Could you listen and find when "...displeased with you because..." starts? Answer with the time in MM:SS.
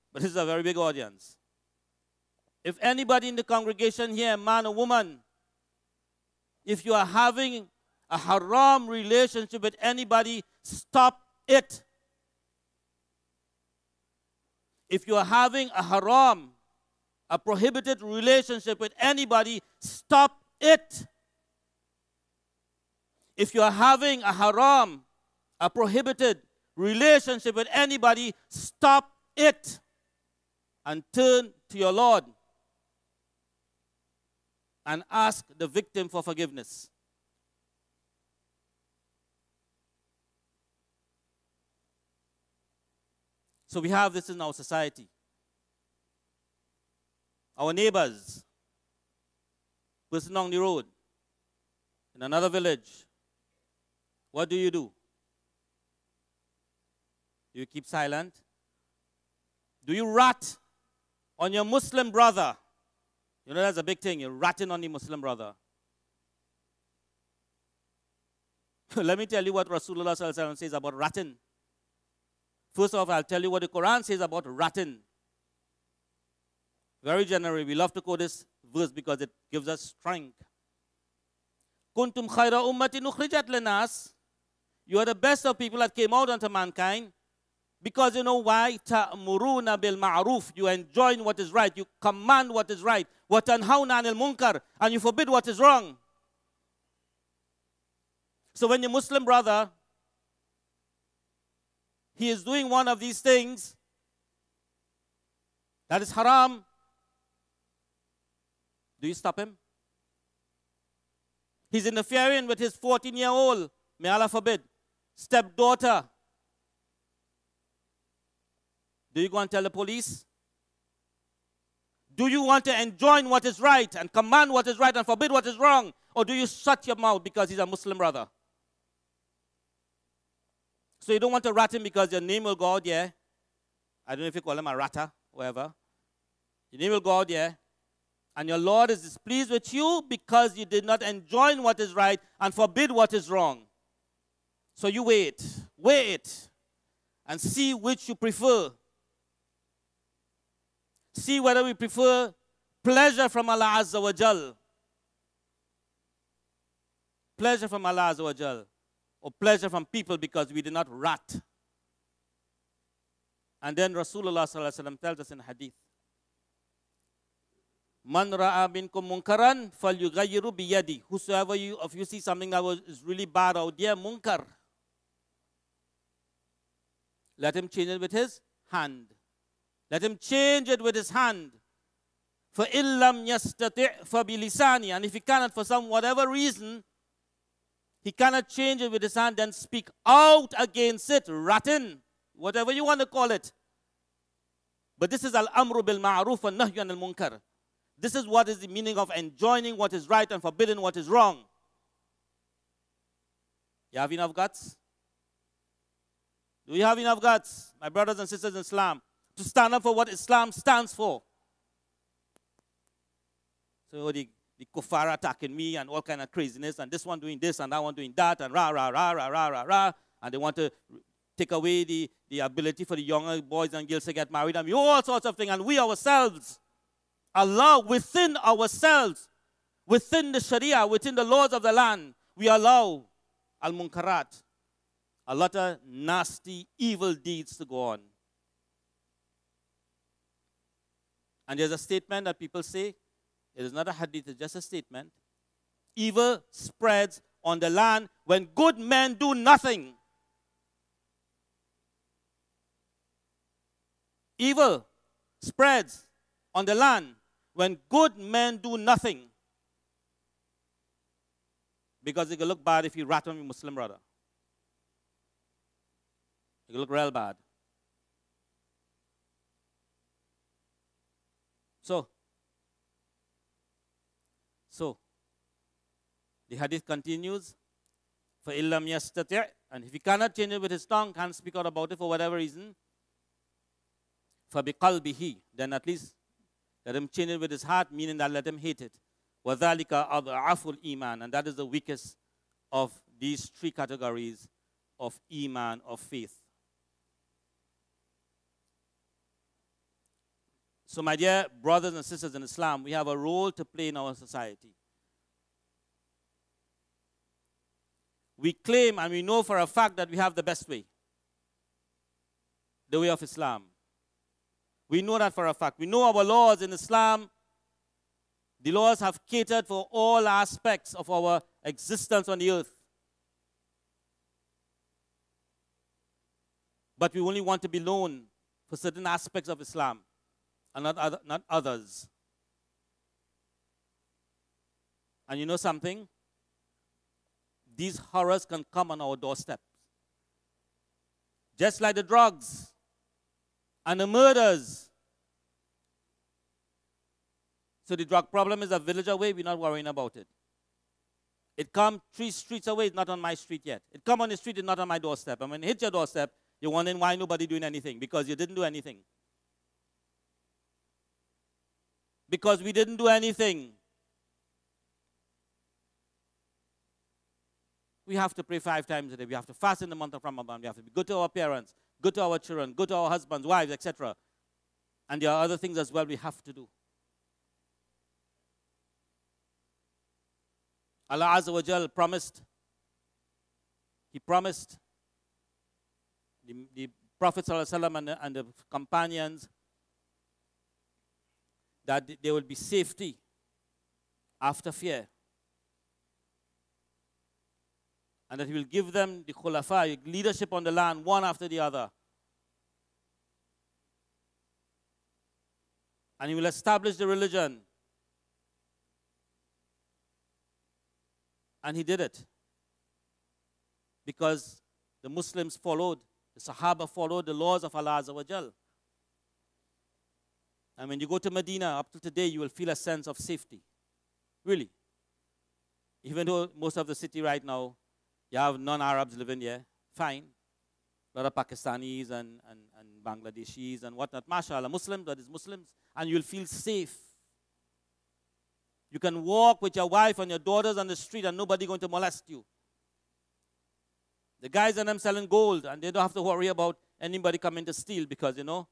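02:19.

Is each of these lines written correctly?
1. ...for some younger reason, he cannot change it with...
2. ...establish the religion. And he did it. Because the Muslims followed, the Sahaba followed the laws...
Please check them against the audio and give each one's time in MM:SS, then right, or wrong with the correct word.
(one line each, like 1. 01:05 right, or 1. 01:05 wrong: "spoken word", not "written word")
1. 03:05 wrong: "whatever", not "younger"
2. 06:46 right.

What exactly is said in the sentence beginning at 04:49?
وَذَلِكَ أَضْعَفُ iman, And that is the weakest of these three categories of iman, of faith.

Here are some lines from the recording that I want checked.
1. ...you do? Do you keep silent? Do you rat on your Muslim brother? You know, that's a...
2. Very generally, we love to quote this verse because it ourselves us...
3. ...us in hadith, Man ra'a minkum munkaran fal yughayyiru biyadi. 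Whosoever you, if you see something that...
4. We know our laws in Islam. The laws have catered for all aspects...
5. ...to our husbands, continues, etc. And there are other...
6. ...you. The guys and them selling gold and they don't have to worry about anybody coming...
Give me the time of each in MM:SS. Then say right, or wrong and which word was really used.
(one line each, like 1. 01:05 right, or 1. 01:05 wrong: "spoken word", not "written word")
1. 00:54 right
2. 01:17 wrong: "gives", not "ourselves"
3. 02:44 right
4. 05:15 right
5. 06:12 wrong: "wives", not "continues"
6. 07:22 right.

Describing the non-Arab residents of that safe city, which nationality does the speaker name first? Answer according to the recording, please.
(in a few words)
Pakistanis.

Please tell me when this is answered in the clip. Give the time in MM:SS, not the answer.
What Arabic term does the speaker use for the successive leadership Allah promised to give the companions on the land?
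06:39.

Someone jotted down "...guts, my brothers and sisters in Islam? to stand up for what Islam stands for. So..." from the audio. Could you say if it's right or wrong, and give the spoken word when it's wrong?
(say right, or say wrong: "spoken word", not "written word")
right.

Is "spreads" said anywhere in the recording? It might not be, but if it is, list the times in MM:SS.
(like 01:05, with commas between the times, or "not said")
04:06, 04:15.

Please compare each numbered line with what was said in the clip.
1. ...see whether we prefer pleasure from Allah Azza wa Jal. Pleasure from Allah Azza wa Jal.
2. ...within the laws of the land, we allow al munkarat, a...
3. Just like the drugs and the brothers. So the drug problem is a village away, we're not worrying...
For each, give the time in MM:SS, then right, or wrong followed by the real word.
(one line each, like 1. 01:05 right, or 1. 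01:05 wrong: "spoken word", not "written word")
1. 02:31 right
2. 03:50 right
3. 05:41 wrong: "murders", not "brothers".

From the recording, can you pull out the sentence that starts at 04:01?
And there's a statement that people say, it is not a hadith, it's just a statement.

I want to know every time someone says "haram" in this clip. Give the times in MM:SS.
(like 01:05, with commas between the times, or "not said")
00:08, 00:15, 00:24, 01:46.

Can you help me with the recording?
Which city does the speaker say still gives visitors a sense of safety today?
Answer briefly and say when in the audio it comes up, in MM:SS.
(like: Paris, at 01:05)
Medina, at 07:01.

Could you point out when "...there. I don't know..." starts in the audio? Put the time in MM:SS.
02:12.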